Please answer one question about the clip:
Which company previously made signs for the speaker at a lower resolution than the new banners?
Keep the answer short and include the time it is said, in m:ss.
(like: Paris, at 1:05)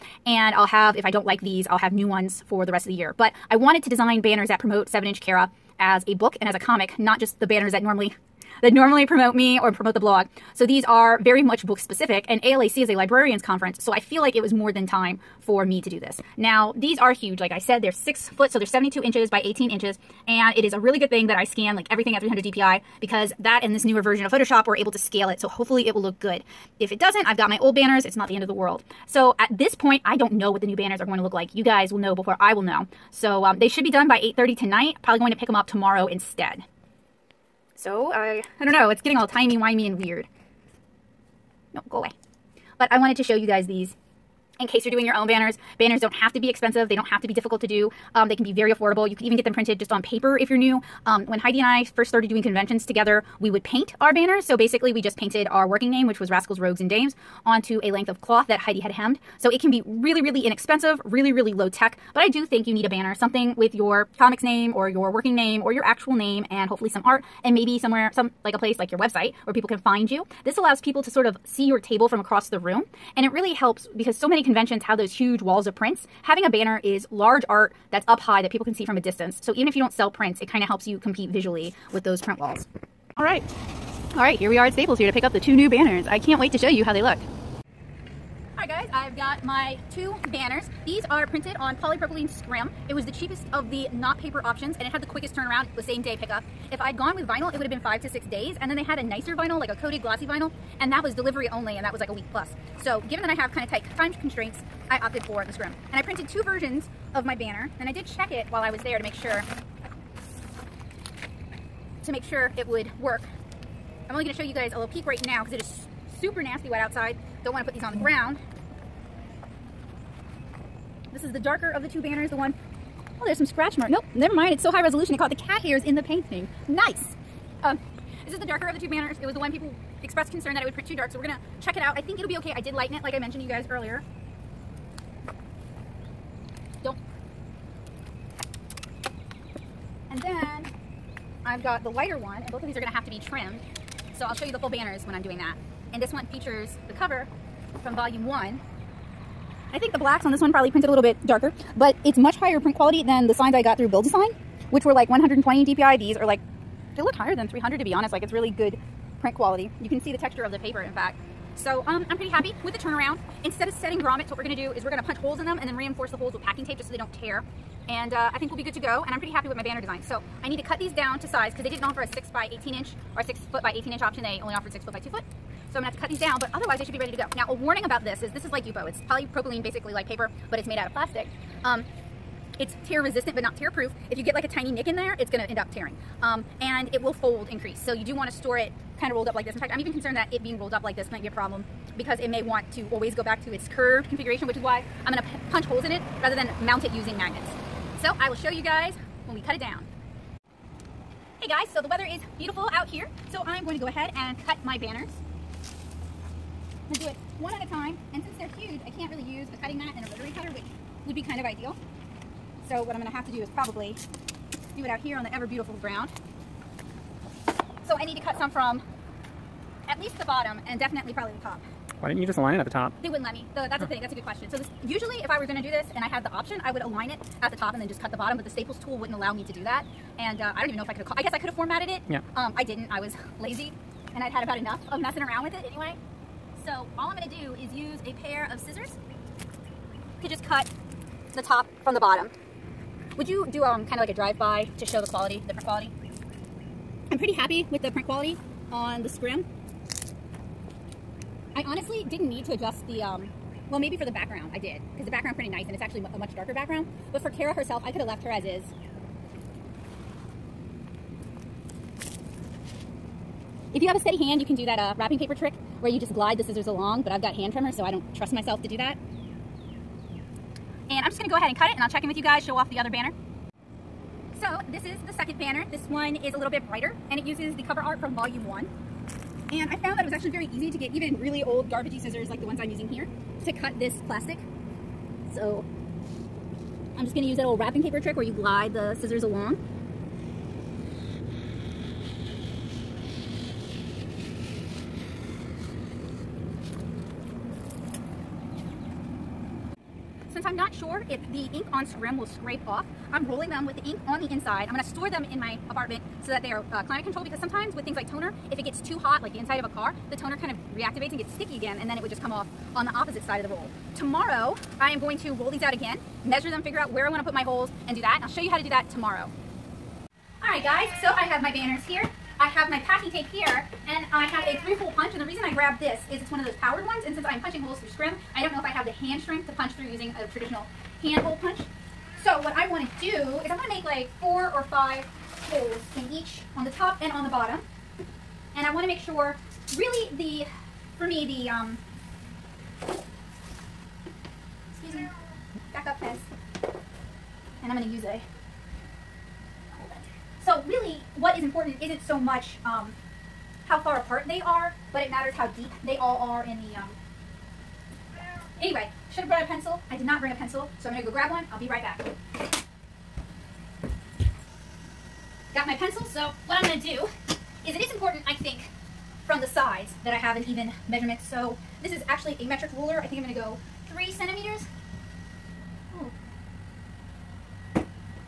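Build a Sign, at 2:33.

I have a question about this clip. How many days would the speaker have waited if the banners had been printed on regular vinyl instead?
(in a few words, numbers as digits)
5 to 6 days.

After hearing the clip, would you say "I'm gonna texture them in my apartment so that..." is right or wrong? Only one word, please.
wrong.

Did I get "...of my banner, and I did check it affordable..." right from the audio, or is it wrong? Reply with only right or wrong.
wrong.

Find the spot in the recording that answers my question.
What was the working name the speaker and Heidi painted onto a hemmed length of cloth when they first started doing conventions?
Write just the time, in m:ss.
0:56.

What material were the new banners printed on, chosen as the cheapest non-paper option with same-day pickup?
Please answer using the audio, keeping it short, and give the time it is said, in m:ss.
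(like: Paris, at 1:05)
polypropylene scrim, at 1:31.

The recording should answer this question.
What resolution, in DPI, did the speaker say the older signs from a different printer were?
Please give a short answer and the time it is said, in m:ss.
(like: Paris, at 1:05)
120 DPI, at 2:35.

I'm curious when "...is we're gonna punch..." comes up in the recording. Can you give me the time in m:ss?
2:44.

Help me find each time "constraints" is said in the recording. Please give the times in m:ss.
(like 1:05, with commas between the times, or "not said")
1:44.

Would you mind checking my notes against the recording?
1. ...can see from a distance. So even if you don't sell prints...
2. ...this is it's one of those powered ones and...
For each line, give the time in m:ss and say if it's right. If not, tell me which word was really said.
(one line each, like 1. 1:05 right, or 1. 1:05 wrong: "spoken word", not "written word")
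1. 1:18 right
2. 5:25 right.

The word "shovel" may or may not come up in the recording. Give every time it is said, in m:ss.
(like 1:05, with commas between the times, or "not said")
not said.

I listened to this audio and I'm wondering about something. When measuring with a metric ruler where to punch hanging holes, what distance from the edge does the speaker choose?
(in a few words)
3 centimeters.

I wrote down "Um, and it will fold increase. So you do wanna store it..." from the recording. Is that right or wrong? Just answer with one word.
right.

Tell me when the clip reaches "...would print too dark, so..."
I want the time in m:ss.
2:10.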